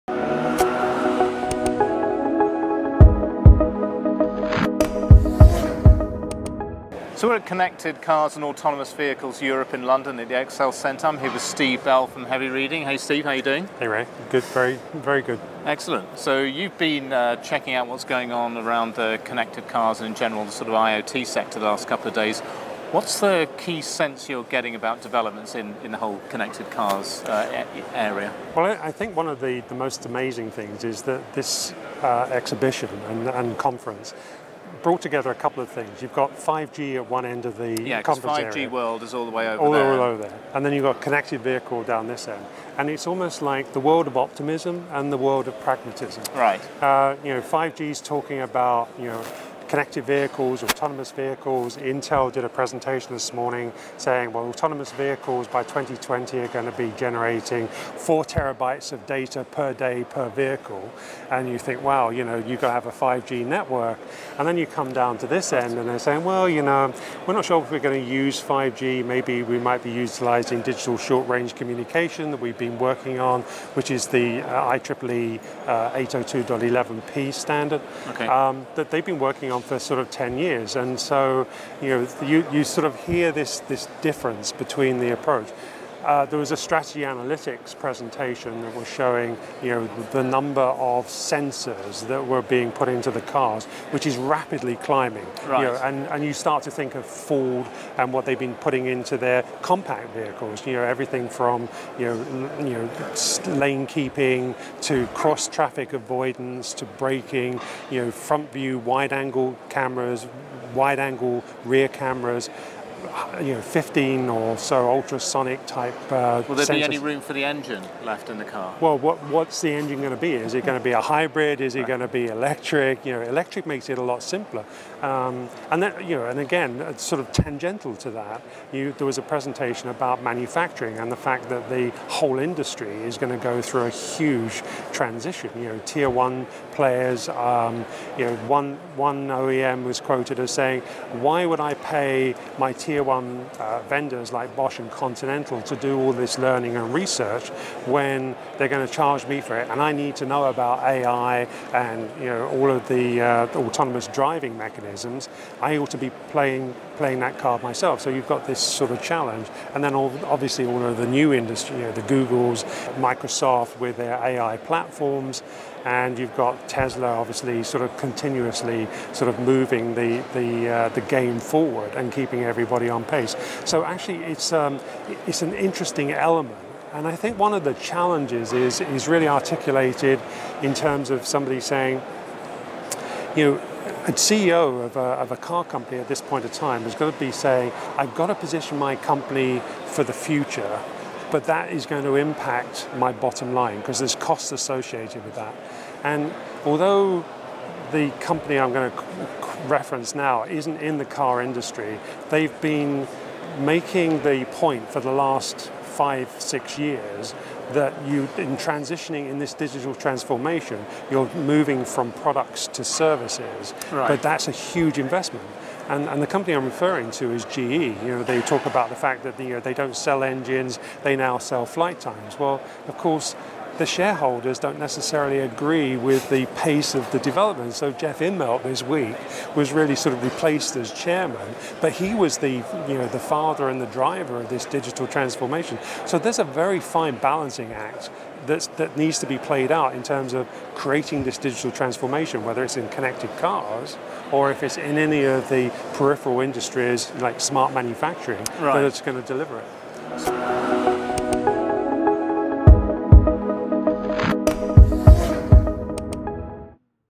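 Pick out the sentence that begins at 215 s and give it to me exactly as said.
And, and, the company I'm referring to is GE.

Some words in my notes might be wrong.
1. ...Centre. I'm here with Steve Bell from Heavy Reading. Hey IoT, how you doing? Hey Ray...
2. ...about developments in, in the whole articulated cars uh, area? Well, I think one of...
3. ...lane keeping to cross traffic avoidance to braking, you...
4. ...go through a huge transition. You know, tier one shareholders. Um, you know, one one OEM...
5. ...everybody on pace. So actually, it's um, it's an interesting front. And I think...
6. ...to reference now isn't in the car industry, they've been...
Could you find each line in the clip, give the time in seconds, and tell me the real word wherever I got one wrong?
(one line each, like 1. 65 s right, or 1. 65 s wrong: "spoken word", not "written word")
1. 10 s wrong: "Steve", not "IoT"
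2. 24 s wrong: "connected", not "articulated"
3. 103 s right
4. 133 s wrong: "players", not "shareholders"
5. 172 s wrong: "element", not "front"
6. 198 s right.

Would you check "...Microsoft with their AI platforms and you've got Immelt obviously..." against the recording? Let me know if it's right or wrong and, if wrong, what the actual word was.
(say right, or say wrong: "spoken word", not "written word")
wrong: "Tesla", not "Immelt".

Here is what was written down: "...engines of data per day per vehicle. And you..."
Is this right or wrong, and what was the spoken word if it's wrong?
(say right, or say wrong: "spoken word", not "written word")
wrong: "terabytes", not "engines".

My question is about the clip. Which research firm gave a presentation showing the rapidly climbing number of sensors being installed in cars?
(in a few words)
Strategy Analytics.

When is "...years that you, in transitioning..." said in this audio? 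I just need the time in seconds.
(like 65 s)
206 s.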